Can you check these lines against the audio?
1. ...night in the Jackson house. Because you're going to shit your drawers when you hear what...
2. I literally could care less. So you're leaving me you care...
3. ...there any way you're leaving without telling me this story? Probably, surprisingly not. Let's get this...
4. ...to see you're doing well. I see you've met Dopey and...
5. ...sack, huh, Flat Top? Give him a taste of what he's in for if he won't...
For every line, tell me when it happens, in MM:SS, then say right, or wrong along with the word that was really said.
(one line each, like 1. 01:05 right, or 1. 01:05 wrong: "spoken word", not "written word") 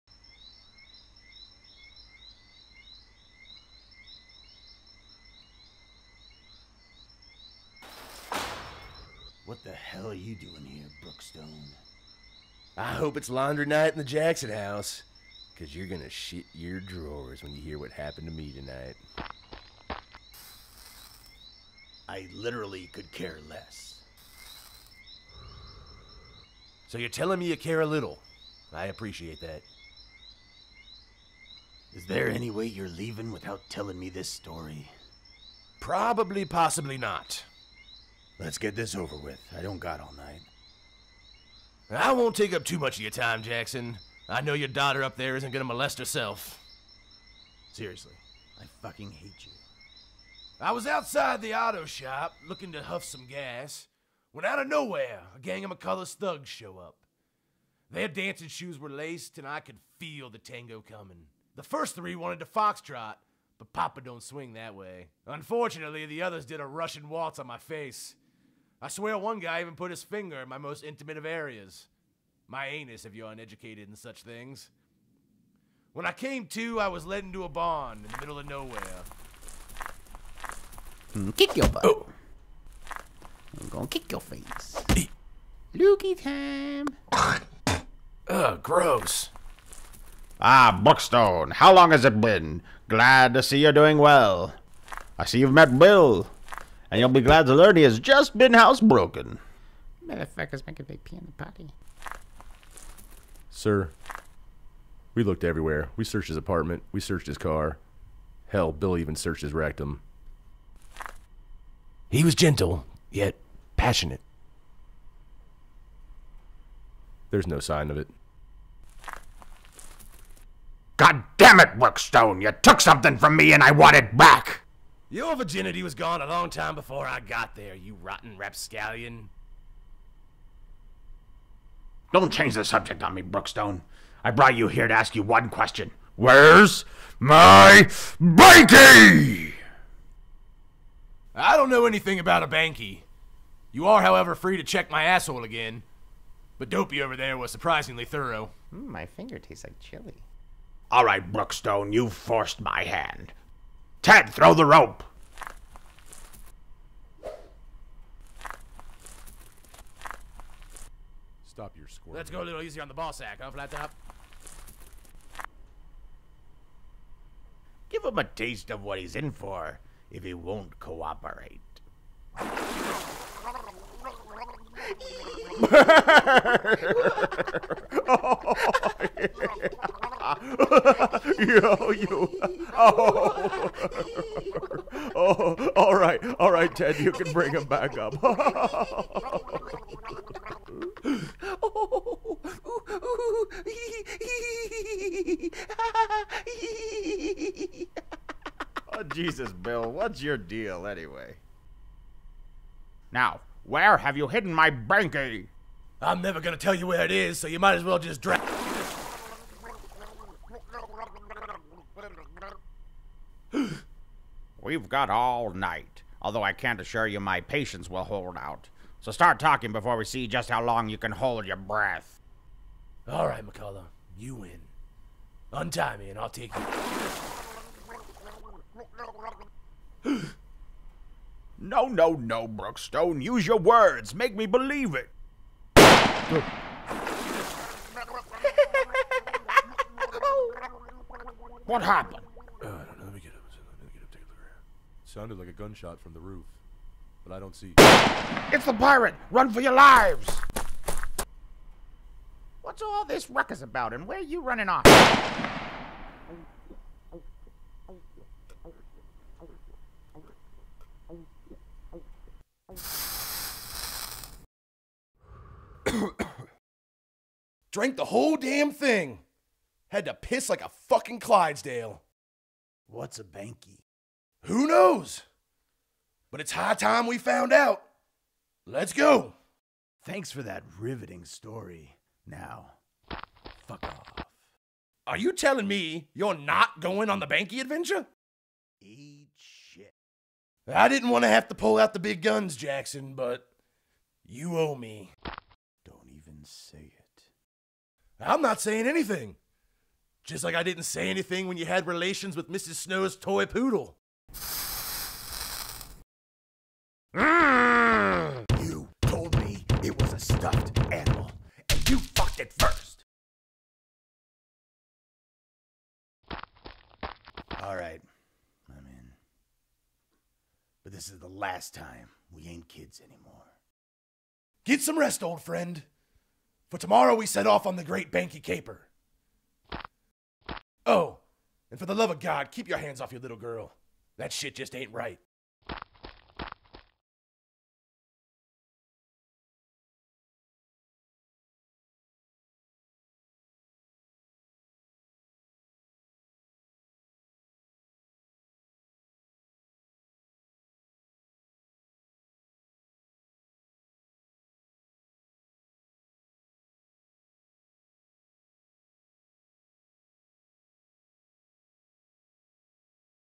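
1. 00:13 right
2. 00:22 wrong: "telling", not "leaving"
3. 00:32 wrong: "possibly", not "surprisingly"
4. 01:33 wrong: "Bill", not "Dopey"
5. 02:43 right.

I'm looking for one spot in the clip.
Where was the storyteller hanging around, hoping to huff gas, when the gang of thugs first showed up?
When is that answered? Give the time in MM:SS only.
00:51.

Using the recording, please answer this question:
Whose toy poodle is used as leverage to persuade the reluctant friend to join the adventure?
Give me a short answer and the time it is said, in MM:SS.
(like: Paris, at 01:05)
Mrs. Snow, at 05:02.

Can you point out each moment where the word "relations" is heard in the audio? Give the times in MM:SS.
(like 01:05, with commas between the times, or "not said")
05:01.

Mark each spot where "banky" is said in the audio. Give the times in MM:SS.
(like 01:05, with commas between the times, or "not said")
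02:18, 02:22, 04:33, 04:47, 05:28.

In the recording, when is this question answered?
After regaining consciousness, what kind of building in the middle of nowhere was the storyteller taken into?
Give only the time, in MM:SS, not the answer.
01:17.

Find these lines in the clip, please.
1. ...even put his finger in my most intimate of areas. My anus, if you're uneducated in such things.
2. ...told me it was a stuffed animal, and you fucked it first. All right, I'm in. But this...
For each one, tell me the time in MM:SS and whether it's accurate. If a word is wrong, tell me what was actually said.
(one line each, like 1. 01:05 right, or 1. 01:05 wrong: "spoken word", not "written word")
1. 01:09 right
2. 05:09 right.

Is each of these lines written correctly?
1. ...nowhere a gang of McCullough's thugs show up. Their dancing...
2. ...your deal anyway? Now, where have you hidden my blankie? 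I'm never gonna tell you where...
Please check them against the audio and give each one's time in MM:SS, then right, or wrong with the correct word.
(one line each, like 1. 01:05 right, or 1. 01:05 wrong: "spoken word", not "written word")
1. 00:54 right
2. 03:20 right.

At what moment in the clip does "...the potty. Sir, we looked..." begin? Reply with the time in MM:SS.
01:41.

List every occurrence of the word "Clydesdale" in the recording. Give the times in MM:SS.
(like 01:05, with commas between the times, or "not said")
04:31.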